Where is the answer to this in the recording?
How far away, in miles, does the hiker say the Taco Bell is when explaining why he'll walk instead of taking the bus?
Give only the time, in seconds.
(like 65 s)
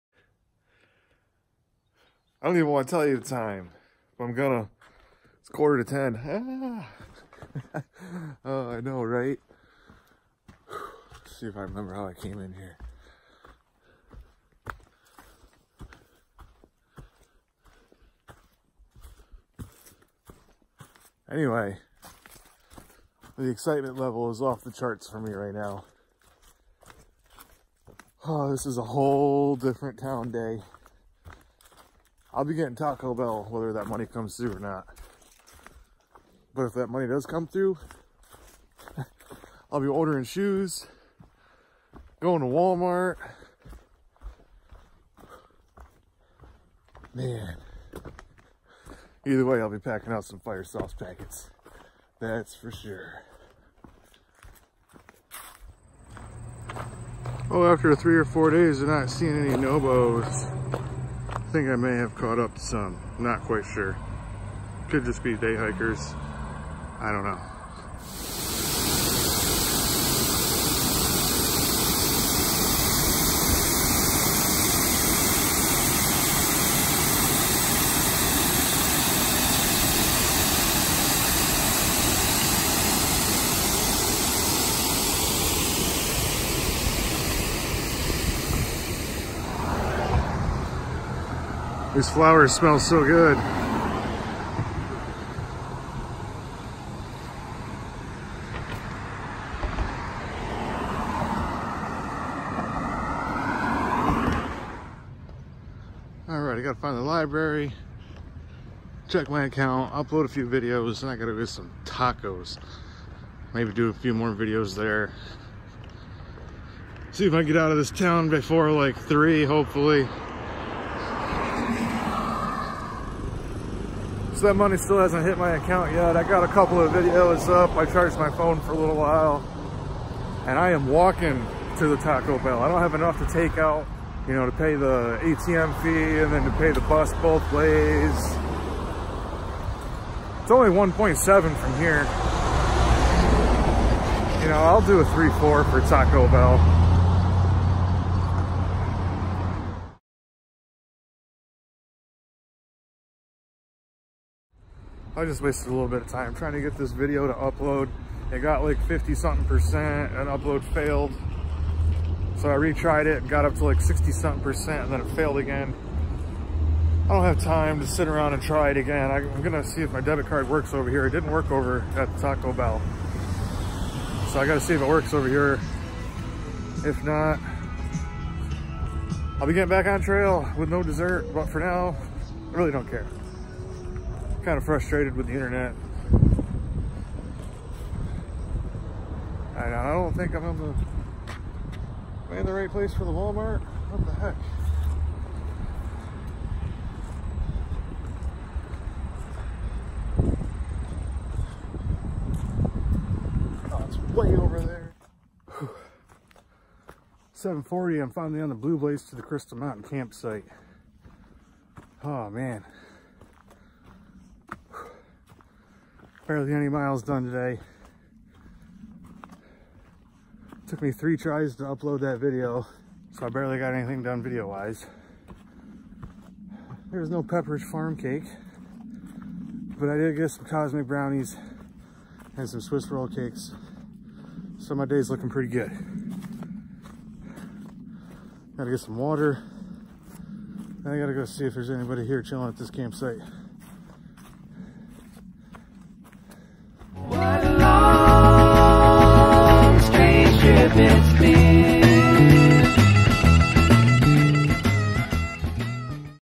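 140 s.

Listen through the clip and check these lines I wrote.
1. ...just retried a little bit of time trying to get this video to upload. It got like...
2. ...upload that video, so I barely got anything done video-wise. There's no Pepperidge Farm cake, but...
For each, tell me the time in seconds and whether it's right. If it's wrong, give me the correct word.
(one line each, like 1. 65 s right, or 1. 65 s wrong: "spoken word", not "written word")
1. 155 s wrong: "wasted", not "retried"
2. 221 s right.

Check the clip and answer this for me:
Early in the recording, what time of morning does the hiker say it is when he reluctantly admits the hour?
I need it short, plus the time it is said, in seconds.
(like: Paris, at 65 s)
Quarter to ten, at 5 s.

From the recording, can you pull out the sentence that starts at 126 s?
I got a couple of videos up.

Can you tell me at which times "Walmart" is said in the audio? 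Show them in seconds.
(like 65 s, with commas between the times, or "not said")
42 s, 193 s.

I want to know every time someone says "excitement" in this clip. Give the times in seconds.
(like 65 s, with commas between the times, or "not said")
23 s.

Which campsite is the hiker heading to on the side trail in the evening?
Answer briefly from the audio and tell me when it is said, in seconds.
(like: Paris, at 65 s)
Crystal Mountain, at 209 s.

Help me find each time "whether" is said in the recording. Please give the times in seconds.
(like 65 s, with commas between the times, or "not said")
33 s.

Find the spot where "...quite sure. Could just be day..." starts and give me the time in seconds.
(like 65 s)
63 s.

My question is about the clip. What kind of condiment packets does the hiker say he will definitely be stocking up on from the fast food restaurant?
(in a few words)
Fire sauce.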